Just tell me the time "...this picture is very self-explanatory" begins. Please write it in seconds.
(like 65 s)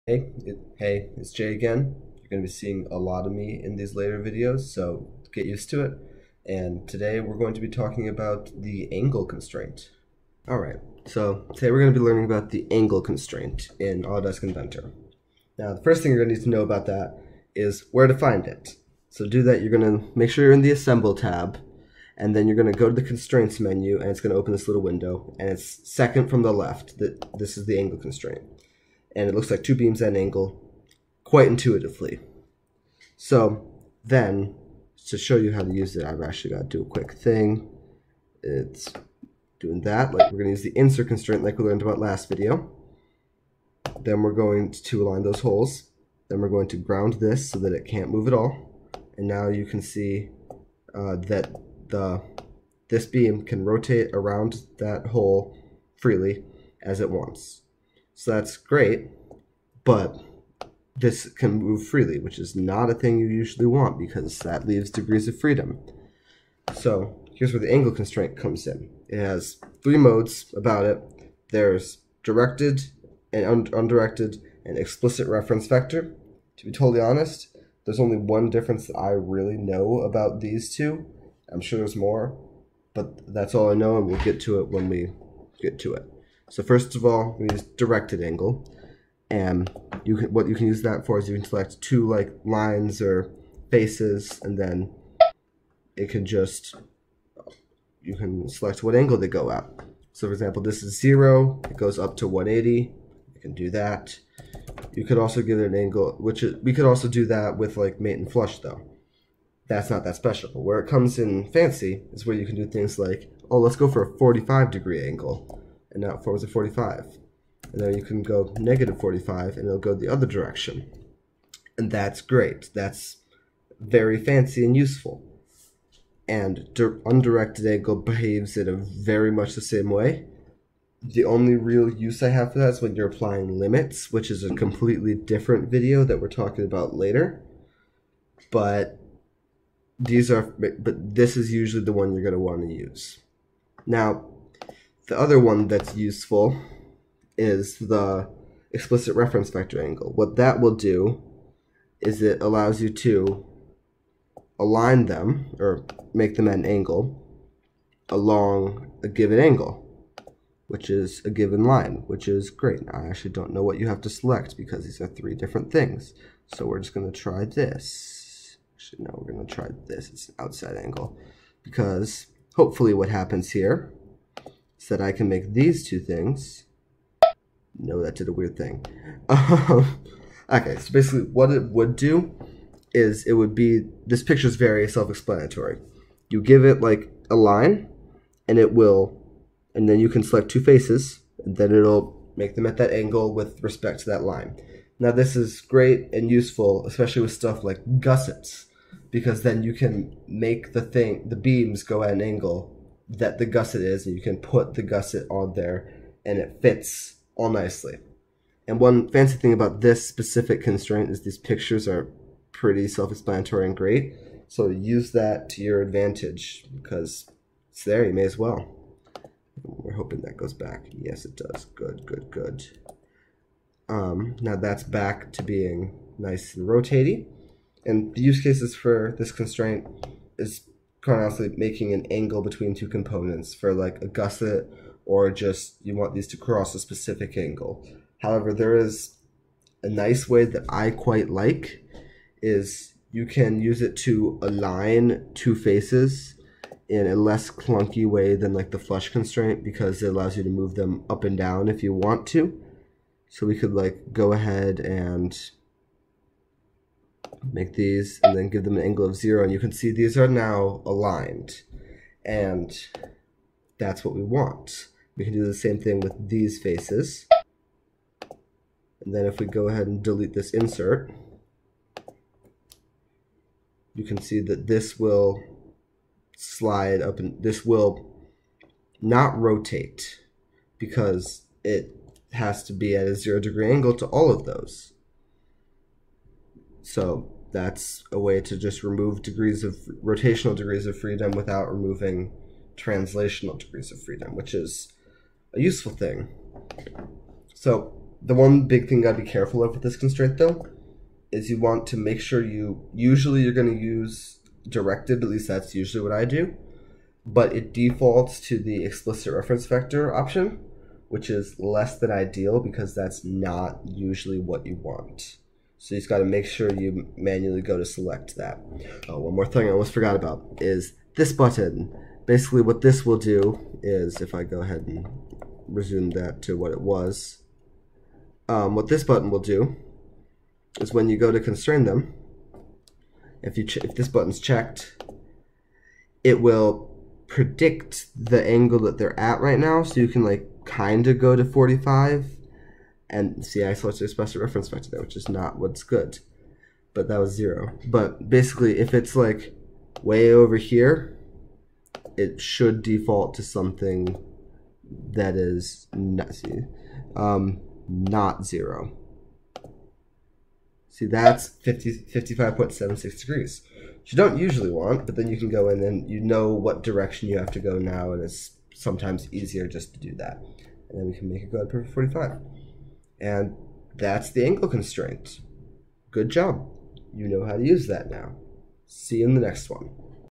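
184 s.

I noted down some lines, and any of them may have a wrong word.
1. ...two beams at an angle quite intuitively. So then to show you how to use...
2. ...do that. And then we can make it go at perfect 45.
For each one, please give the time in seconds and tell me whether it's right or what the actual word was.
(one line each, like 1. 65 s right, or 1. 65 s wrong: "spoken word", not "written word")
1. 29 s right
2. 369 s right.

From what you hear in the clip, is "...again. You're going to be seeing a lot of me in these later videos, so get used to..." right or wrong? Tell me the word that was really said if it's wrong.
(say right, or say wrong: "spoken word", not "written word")
right.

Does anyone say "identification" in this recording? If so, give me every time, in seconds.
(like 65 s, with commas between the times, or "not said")
not said.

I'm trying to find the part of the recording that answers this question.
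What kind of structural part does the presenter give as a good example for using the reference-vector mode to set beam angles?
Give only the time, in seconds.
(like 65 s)
197 s.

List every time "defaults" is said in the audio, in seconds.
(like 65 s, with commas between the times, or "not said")
307 s, 352 s.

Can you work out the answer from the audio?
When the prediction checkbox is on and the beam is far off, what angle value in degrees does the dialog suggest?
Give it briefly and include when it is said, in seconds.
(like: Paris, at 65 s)
55.76, at 361 s.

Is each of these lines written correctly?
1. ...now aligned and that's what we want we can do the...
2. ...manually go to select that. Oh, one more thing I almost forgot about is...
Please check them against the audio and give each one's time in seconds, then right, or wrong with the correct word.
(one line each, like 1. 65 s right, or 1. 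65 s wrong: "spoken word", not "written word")
1. 260 s right
2. 317 s right.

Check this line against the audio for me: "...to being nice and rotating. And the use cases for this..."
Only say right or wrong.
right.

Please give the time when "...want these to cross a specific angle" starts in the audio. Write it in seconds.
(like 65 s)
235 s.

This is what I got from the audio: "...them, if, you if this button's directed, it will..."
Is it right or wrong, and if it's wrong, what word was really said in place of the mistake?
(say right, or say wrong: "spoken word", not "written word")
wrong: "checked", not "directed".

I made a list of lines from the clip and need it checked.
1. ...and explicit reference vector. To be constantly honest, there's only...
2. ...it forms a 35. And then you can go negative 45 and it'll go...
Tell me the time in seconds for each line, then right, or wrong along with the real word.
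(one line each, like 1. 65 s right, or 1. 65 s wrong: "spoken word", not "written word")
1. 74 s wrong: "totally", not "constantly"
2. 116 s wrong: "45", not "35".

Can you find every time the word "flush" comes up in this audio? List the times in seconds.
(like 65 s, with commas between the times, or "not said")
108 s, 248 s.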